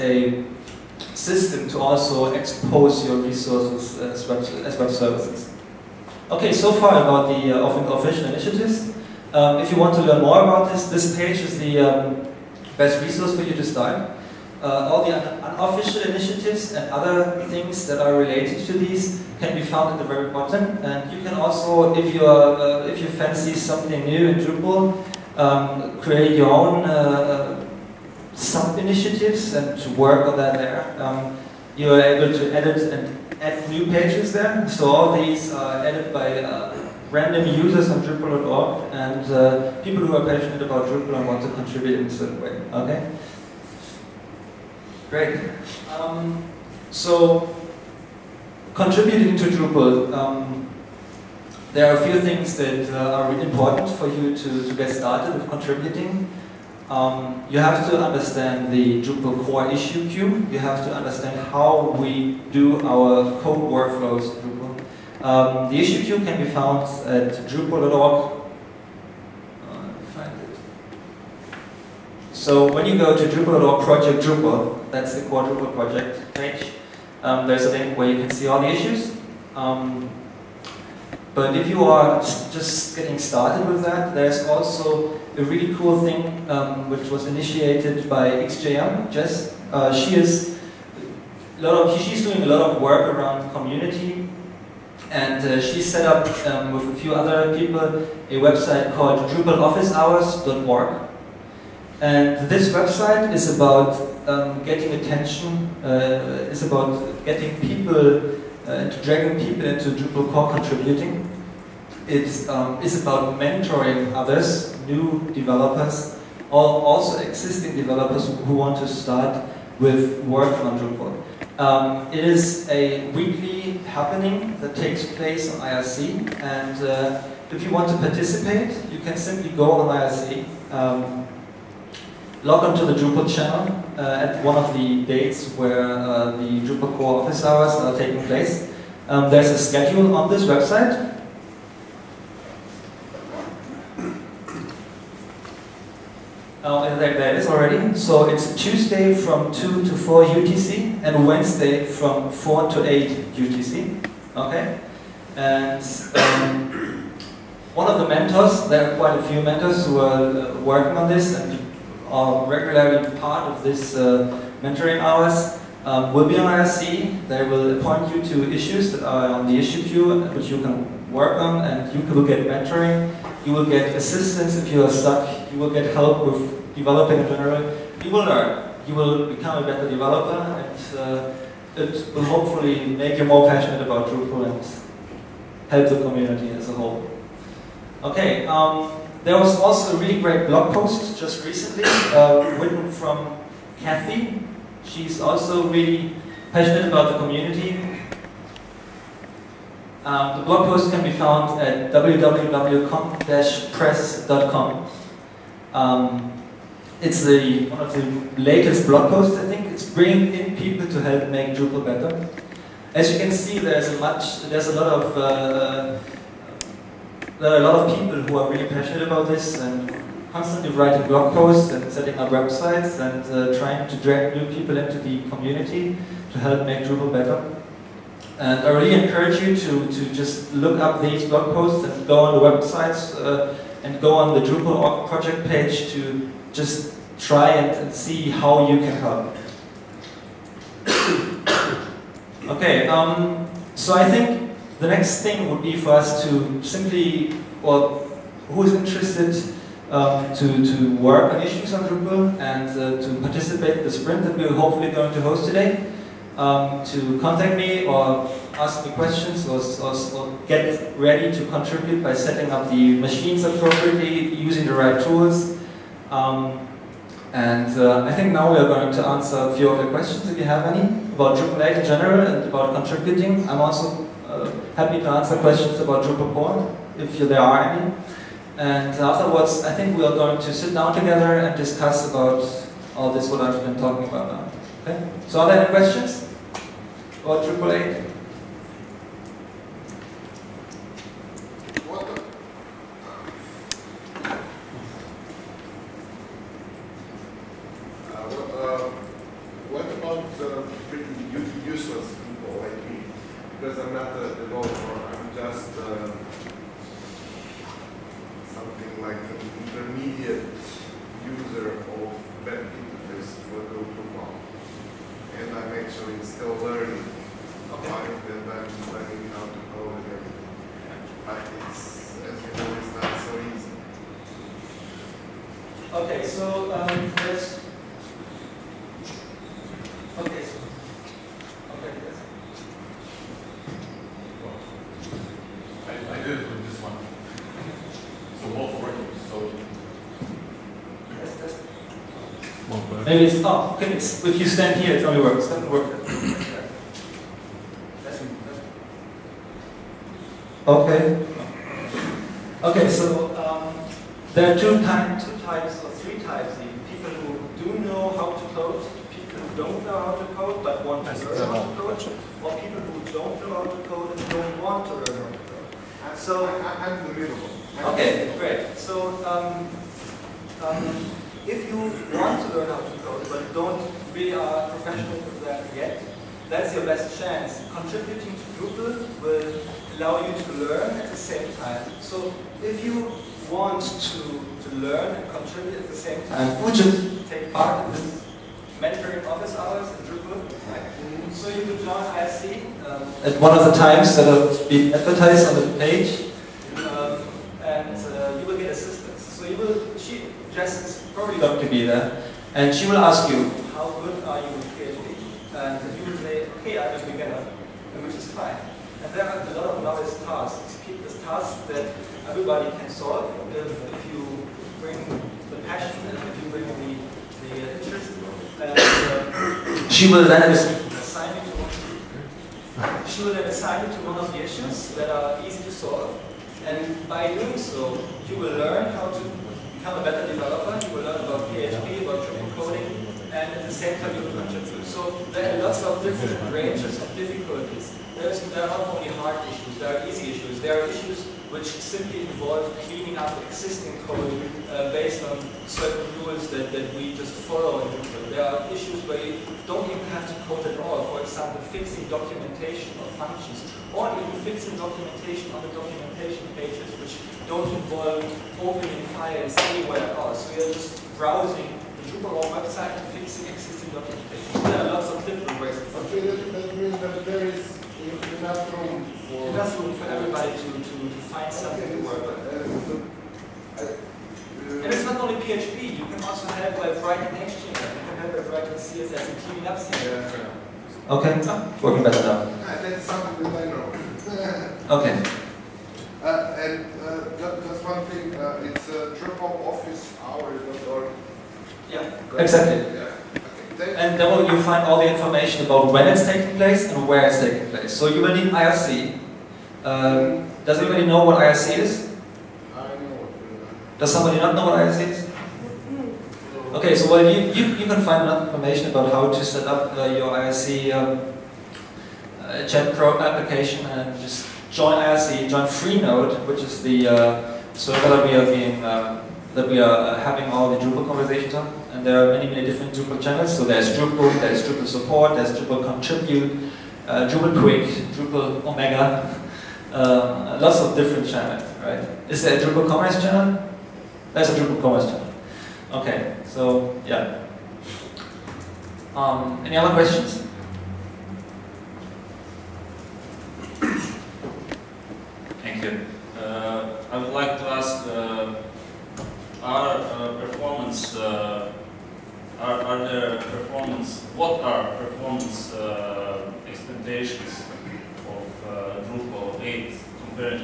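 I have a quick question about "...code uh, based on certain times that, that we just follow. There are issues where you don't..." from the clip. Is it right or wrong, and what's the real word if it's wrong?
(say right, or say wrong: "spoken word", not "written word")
wrong: "rules", not "times".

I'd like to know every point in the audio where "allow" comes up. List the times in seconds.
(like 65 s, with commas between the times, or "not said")
379 s.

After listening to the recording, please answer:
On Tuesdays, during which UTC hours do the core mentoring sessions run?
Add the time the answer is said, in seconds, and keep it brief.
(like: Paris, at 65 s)
2 to 4, at 149 s.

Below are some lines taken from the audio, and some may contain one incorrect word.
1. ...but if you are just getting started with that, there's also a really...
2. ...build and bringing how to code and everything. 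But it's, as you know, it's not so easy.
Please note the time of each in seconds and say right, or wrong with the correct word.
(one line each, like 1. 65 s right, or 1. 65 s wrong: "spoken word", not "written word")
1. 81 s right
2. 318 s wrong: "learning", not "bringing".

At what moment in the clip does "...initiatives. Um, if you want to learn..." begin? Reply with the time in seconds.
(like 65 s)
8 s.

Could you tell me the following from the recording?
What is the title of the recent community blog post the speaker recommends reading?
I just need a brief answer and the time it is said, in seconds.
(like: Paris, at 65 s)
Bringing in people to help make Drupal better, at 209 s.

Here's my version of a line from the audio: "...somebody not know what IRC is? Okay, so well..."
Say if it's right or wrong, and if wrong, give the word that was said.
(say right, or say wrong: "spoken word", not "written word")
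right.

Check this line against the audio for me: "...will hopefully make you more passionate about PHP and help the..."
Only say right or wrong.
wrong.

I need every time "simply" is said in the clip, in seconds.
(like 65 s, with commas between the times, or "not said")
129 s, 246 s, 441 s.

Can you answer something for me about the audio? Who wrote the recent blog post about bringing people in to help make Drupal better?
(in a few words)
Kathy.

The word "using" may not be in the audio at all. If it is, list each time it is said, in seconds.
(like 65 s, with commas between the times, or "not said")
264 s.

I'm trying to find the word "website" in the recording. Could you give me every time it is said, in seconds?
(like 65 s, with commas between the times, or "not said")
98 s, 102 s, 140 s, 222 s, 232 s, 462 s.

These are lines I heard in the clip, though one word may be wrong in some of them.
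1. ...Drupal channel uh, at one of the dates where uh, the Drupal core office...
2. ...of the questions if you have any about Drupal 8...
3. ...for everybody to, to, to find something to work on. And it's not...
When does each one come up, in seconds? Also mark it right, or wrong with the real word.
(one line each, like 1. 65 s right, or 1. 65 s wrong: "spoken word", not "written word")
1. 132 s right
2. 269 s right
3. 469 s right.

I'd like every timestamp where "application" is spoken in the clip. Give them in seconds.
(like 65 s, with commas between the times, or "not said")
513 s.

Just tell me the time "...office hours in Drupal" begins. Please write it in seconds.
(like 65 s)
389 s.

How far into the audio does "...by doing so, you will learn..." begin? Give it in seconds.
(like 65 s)
427 s.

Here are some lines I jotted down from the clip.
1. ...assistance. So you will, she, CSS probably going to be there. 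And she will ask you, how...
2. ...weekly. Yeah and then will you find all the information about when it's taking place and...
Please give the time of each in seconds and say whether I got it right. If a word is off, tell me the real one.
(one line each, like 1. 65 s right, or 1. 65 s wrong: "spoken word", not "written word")
1. 398 s wrong: "Jess", not "CSS"
2. 492 s wrong: "exactly", not "weekly".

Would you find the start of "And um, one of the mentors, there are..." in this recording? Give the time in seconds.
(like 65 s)
155 s.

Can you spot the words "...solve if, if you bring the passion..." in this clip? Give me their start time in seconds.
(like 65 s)
412 s.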